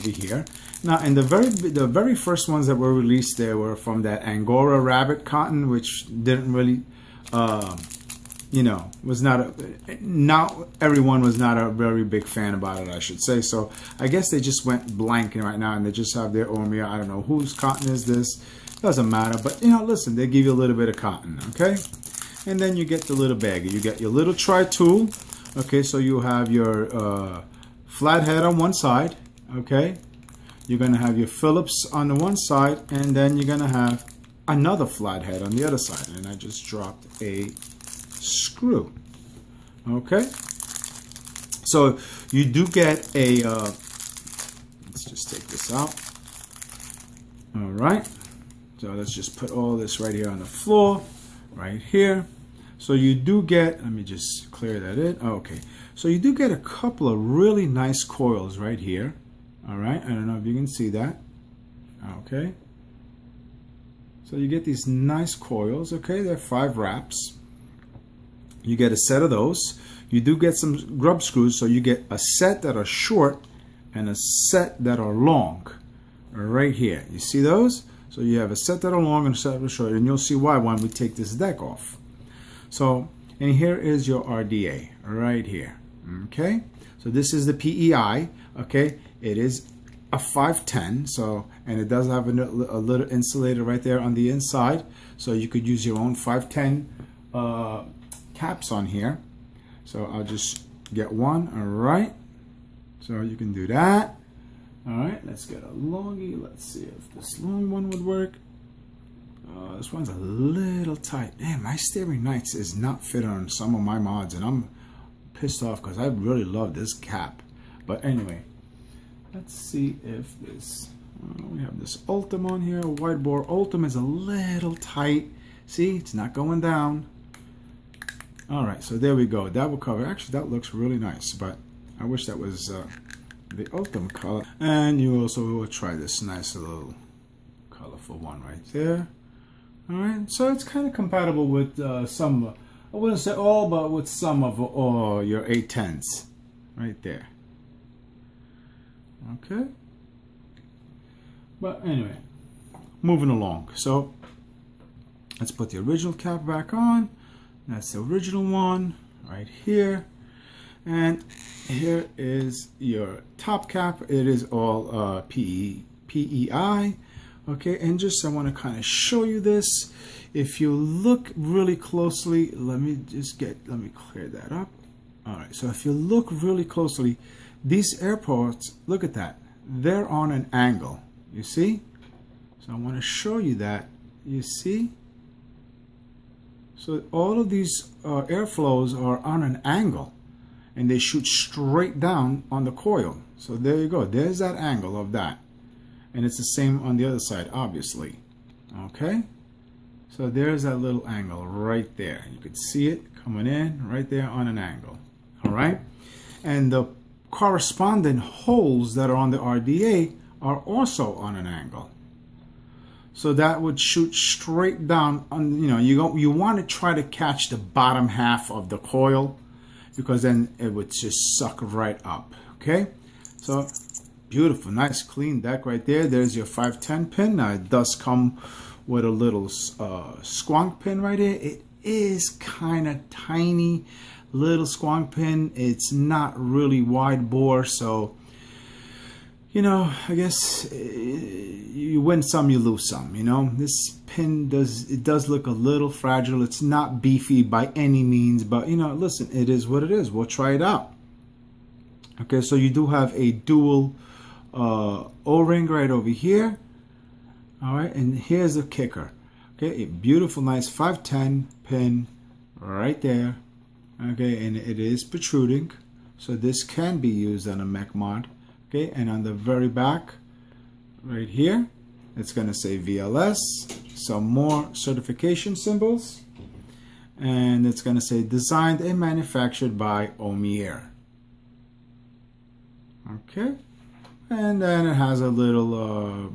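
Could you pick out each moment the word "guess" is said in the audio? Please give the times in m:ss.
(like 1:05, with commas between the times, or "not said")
0:14, 4:00.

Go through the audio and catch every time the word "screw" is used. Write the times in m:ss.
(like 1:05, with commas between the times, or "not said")
0:38, 1:11.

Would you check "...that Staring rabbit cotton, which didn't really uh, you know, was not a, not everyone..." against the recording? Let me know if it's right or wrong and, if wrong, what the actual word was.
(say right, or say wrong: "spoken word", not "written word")
wrong: "Angora", not "Staring".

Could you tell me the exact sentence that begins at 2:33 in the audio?
So let's put the original cap back on.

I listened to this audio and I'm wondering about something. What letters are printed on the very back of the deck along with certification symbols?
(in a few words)
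VLS.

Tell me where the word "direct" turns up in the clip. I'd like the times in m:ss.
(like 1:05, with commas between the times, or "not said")
not said.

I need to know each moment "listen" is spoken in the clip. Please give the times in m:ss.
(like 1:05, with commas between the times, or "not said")
0:19, 4:08.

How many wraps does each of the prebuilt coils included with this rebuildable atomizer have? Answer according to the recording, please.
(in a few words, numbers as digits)
5.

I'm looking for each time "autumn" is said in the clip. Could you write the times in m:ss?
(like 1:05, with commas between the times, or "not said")
2:13.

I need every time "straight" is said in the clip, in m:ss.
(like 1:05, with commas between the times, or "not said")
3:11, 3:34.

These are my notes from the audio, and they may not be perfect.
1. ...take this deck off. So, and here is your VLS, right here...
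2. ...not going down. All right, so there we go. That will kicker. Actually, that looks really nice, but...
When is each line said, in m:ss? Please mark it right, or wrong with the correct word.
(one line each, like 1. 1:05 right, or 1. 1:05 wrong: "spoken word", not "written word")
1. 1:20 wrong: "RDA", not "VLS"
2. 2:06 wrong: "cover", not "kicker".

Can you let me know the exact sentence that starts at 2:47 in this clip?
Okay, and just I want to kind of show you this.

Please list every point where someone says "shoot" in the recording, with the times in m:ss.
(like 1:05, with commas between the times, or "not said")
3:10, 3:33.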